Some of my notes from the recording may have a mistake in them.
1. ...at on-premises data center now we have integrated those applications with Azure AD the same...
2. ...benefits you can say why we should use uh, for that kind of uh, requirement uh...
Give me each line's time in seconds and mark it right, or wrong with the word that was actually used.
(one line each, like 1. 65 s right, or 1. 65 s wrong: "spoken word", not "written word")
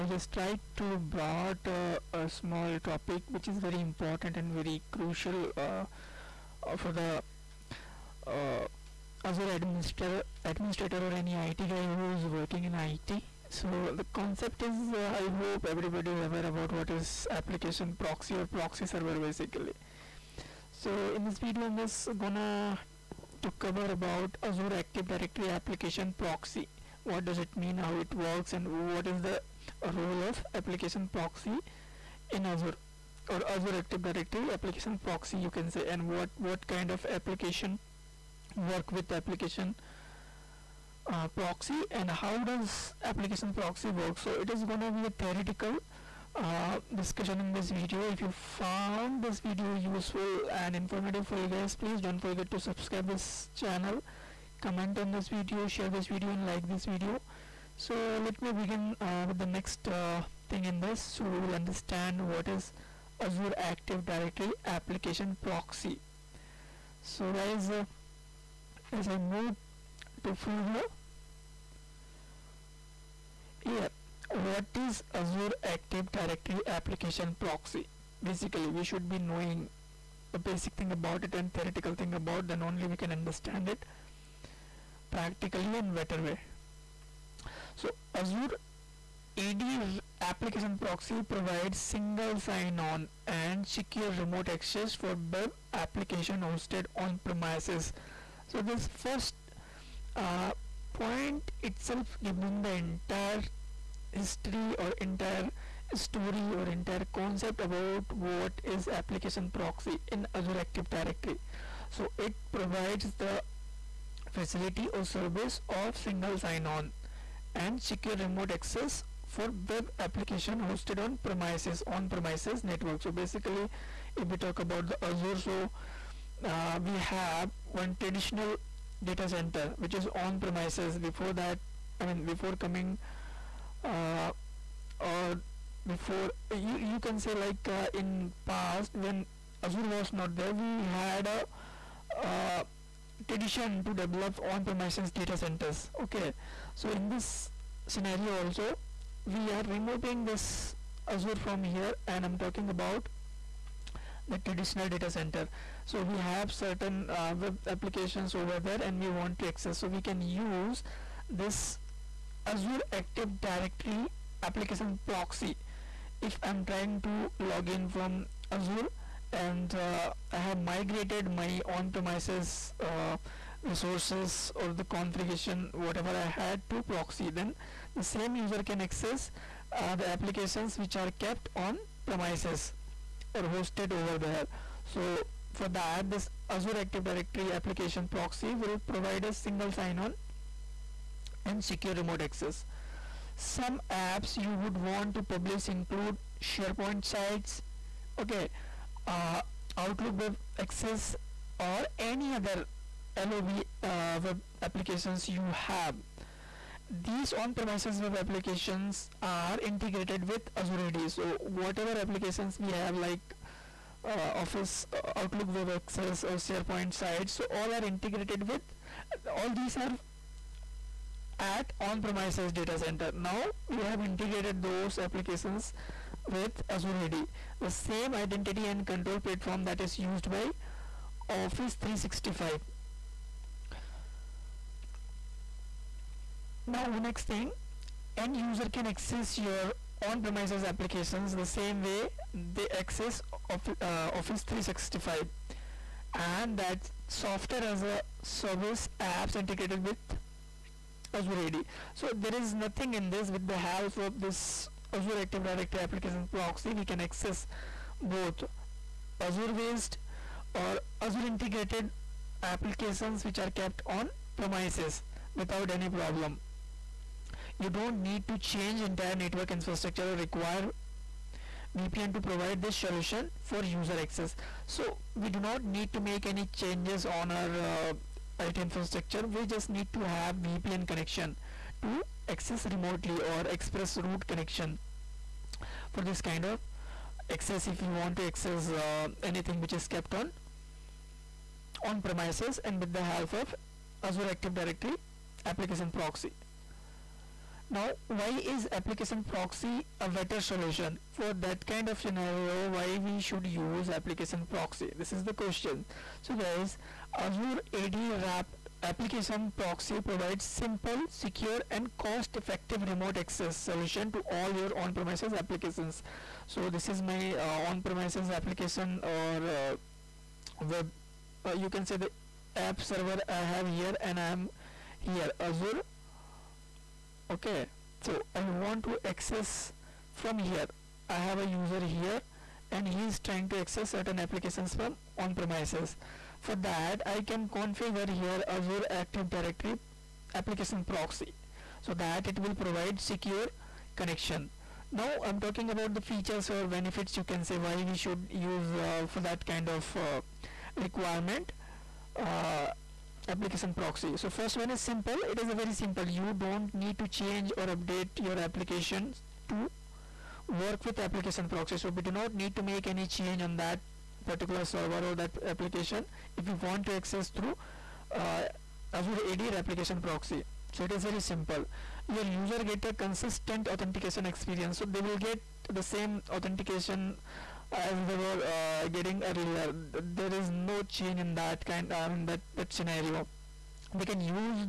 1. 221 s right
2. 346 s right.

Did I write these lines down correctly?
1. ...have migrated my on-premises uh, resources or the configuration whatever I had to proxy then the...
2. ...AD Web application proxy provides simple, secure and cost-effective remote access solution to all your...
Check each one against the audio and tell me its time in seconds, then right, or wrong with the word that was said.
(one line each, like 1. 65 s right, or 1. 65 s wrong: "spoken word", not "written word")
1. 170 s right
2. 307 s wrong: "Wrap", not "Web".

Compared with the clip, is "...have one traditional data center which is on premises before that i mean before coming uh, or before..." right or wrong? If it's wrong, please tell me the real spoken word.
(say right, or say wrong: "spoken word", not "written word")
right.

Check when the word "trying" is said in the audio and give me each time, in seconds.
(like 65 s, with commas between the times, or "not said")
166 s, 333 s.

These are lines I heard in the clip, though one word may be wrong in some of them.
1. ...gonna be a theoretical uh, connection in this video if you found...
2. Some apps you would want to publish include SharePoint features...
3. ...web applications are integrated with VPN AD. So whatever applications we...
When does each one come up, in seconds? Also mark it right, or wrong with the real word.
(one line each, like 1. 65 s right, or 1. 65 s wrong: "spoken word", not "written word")
1. 44 s wrong: "discussion", not "connection"
2. 193 s wrong: "sites", not "features"
3. 207 s wrong: "Azure", not "VPN".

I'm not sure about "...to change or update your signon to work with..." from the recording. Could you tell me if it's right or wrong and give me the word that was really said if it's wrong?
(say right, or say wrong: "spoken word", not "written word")
wrong: "application", not "signon".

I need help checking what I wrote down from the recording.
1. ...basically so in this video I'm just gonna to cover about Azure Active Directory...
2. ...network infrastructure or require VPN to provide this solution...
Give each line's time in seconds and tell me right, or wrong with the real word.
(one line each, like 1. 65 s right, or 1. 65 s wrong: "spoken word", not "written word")
1. 19 s right
2. 269 s right.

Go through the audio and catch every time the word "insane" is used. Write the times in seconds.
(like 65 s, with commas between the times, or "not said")
not said.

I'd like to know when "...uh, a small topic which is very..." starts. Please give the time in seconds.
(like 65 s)
1 s.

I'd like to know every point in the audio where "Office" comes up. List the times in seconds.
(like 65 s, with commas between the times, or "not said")
214 s, 231 s, 244 s.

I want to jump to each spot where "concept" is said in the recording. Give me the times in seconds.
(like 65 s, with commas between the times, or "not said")
14 s, 107 s.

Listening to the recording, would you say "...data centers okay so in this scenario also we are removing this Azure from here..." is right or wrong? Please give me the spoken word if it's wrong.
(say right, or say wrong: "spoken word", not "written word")
right.